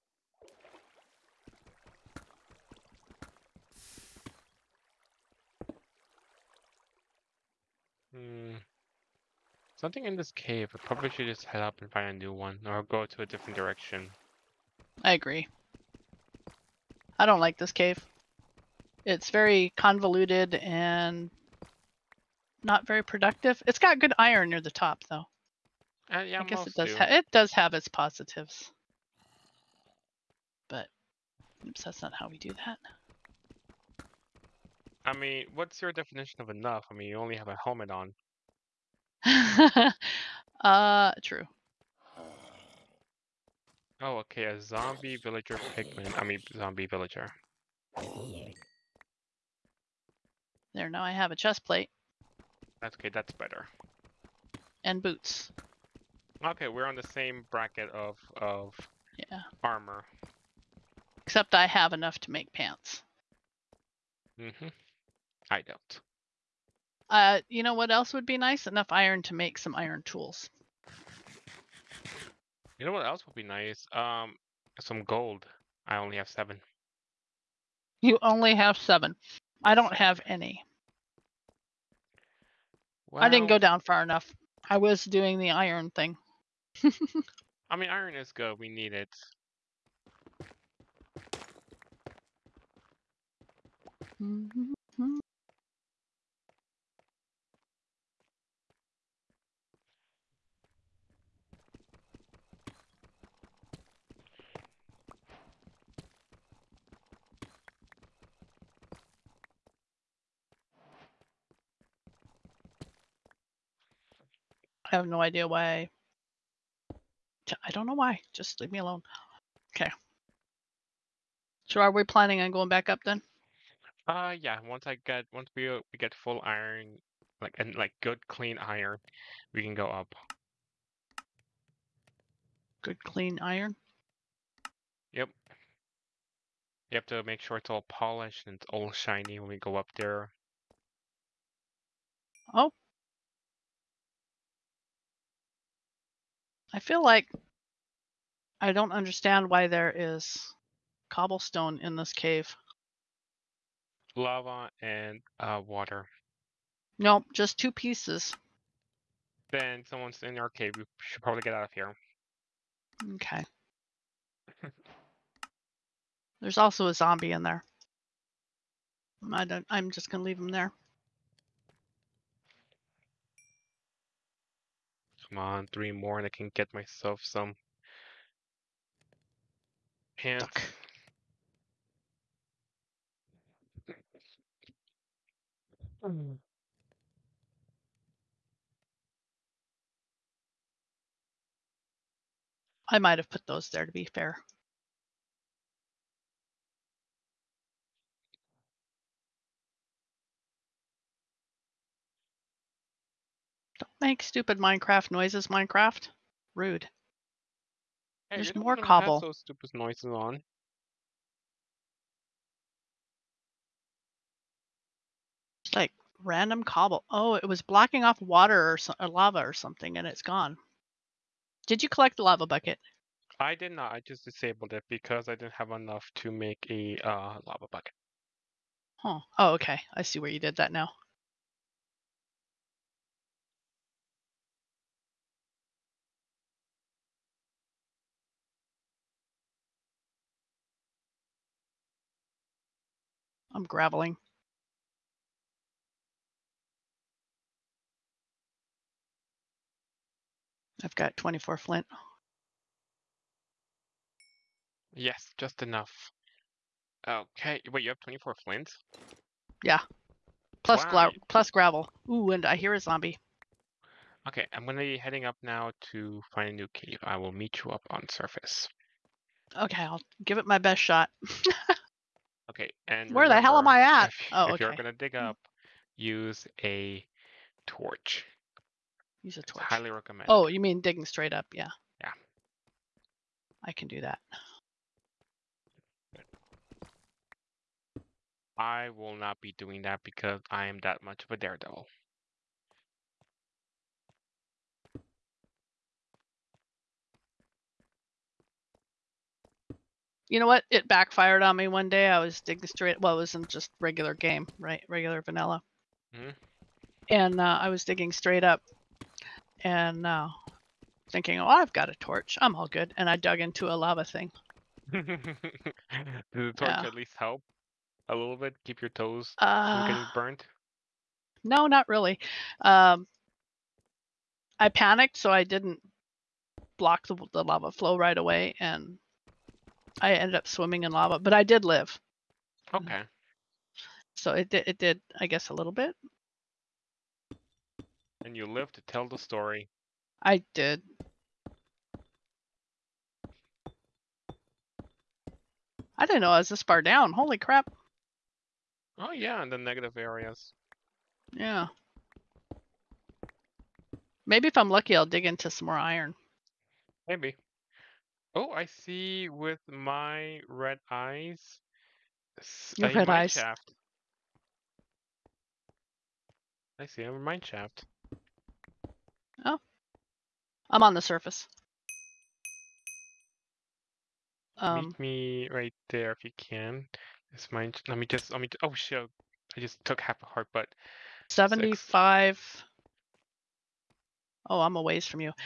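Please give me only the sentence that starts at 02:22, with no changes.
Oh, I feel like I don't understand why there is cobblestone in this cave.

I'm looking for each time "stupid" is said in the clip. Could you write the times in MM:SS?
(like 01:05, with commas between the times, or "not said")
03:24, 03:29.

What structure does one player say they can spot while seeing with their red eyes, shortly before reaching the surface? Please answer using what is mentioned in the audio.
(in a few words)
Mine shaft.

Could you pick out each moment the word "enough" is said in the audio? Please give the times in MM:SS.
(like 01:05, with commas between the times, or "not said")
00:36, 01:01, 01:08, 01:24, 03:45, 04:15.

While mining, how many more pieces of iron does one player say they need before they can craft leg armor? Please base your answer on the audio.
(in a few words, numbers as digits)
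3.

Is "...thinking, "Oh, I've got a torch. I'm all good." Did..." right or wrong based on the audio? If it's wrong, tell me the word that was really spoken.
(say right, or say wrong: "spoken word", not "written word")
wrong: "And", not "Did".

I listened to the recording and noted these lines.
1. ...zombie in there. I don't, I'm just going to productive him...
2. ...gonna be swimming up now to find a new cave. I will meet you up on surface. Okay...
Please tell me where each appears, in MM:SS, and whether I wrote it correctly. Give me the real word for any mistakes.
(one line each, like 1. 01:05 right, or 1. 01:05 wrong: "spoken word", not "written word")
1. 02:46 wrong: "leave", not "productive"
2. 04:24 wrong: "heading", not "swimming".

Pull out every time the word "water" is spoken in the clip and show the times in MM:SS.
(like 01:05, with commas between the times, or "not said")
02:35, 03:38.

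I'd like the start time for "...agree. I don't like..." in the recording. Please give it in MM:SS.
00:15.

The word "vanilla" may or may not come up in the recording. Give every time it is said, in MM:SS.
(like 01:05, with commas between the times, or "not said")
05:05.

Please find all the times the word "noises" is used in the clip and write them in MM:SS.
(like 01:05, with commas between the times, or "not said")
03:25, 03:29.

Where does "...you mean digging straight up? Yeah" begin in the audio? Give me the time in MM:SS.
04:40.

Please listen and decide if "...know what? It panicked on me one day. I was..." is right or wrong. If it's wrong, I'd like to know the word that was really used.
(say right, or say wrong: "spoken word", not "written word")
wrong: "backfired", not "panicked".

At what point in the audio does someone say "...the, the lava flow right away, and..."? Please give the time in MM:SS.
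05:27.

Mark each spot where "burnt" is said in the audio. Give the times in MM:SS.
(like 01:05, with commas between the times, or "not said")
05:20.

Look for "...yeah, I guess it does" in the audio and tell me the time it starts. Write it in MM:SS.
00:26.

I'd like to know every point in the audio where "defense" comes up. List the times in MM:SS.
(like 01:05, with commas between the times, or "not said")
not said.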